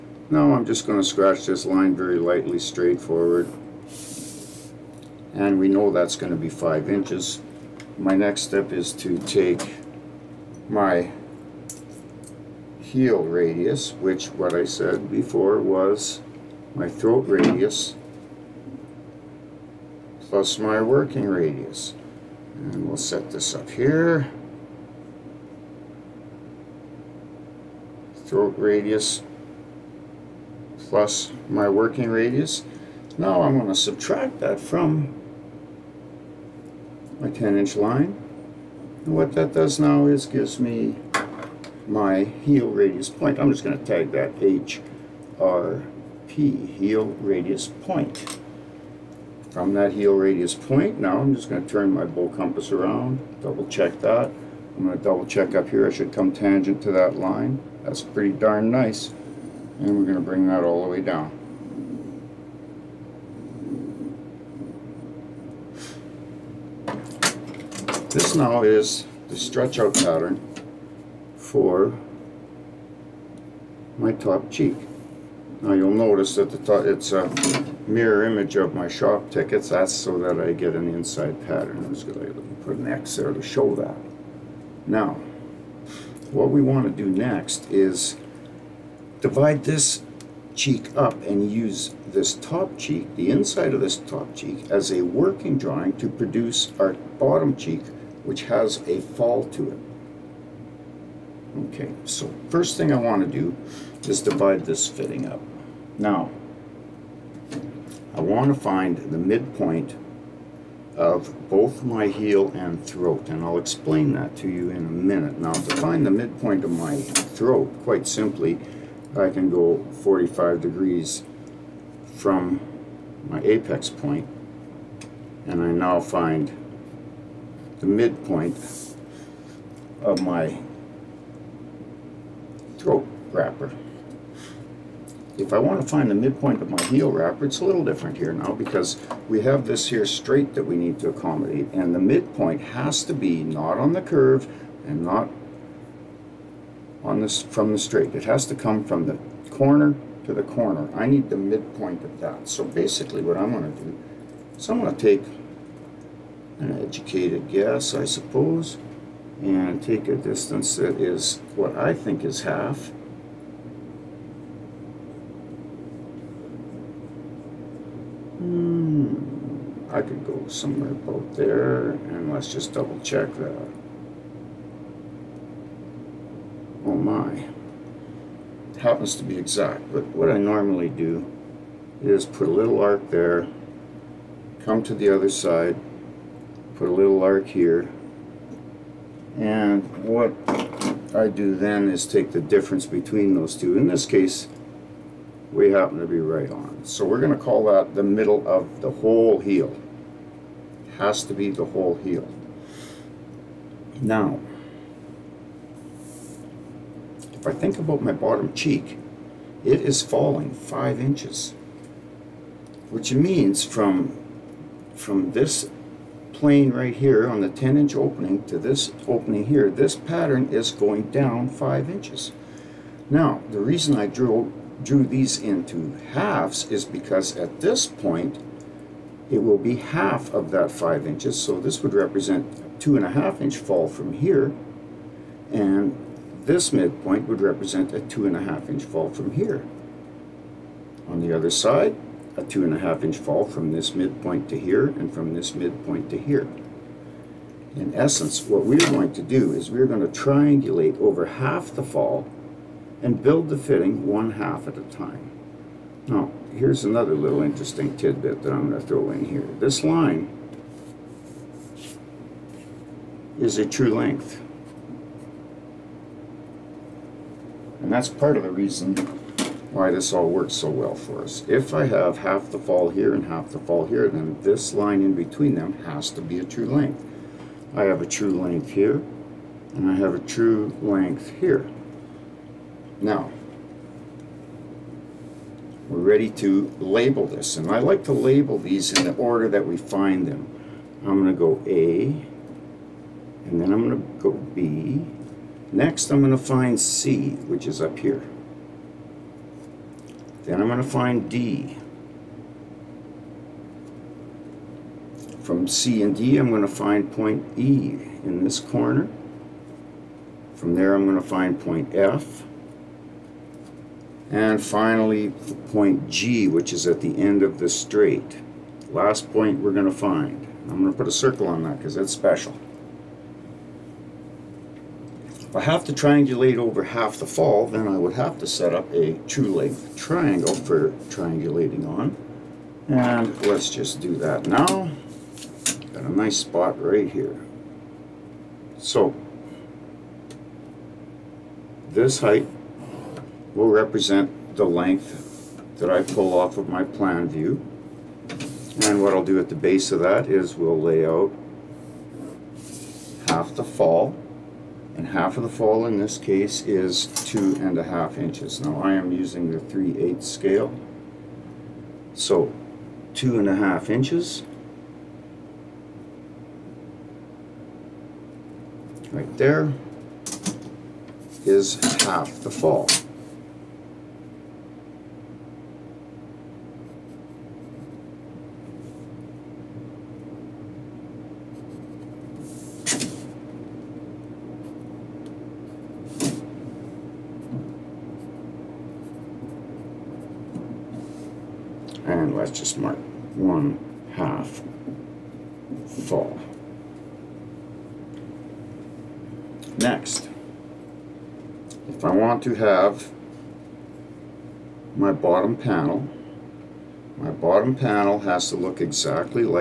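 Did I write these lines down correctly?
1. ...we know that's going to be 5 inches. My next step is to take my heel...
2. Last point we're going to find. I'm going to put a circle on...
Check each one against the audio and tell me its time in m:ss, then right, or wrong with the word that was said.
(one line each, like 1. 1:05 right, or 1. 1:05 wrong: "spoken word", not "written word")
1. 0:05 right
2. 5:18 right.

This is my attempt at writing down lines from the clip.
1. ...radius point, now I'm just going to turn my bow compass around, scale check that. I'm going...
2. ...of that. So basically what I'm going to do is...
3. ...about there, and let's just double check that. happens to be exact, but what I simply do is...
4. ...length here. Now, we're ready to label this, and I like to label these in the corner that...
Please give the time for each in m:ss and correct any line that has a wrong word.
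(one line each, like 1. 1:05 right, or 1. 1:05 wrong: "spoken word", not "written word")
1. 0:50 wrong: "double", not "scale"
2. 2:32 right
3. 2:50 wrong: "normally", not "simply"
4. 4:40 wrong: "order", not "corner".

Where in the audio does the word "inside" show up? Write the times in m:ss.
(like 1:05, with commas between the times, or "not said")
1:20, 1:33.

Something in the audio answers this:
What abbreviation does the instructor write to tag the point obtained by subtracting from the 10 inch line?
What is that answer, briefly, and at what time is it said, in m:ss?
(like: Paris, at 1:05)
HRP, at 0:44.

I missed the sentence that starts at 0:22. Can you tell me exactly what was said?
And we'll set this up here.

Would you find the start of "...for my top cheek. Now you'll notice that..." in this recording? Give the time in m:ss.
1:11.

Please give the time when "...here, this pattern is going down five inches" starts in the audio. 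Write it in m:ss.
3:39.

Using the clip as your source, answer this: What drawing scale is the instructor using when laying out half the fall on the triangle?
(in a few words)
3/8 scale.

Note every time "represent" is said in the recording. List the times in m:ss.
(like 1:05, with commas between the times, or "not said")
3:51, 3:57, 5:43.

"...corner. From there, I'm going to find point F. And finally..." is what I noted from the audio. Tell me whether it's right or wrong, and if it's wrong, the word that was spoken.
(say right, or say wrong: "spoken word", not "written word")
right.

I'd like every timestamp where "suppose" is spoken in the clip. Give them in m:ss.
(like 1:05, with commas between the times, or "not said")
2:38.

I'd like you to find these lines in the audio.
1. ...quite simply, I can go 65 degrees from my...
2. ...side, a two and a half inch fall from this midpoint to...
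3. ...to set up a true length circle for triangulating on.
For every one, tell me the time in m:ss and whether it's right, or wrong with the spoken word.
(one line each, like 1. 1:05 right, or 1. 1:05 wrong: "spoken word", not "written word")
1. 1:57 wrong: "45", not "65"
2. 4:01 right
3. 5:28 wrong: "triangle", not "circle".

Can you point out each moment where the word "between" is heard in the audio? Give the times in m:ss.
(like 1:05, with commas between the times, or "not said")
3:12, 4:35.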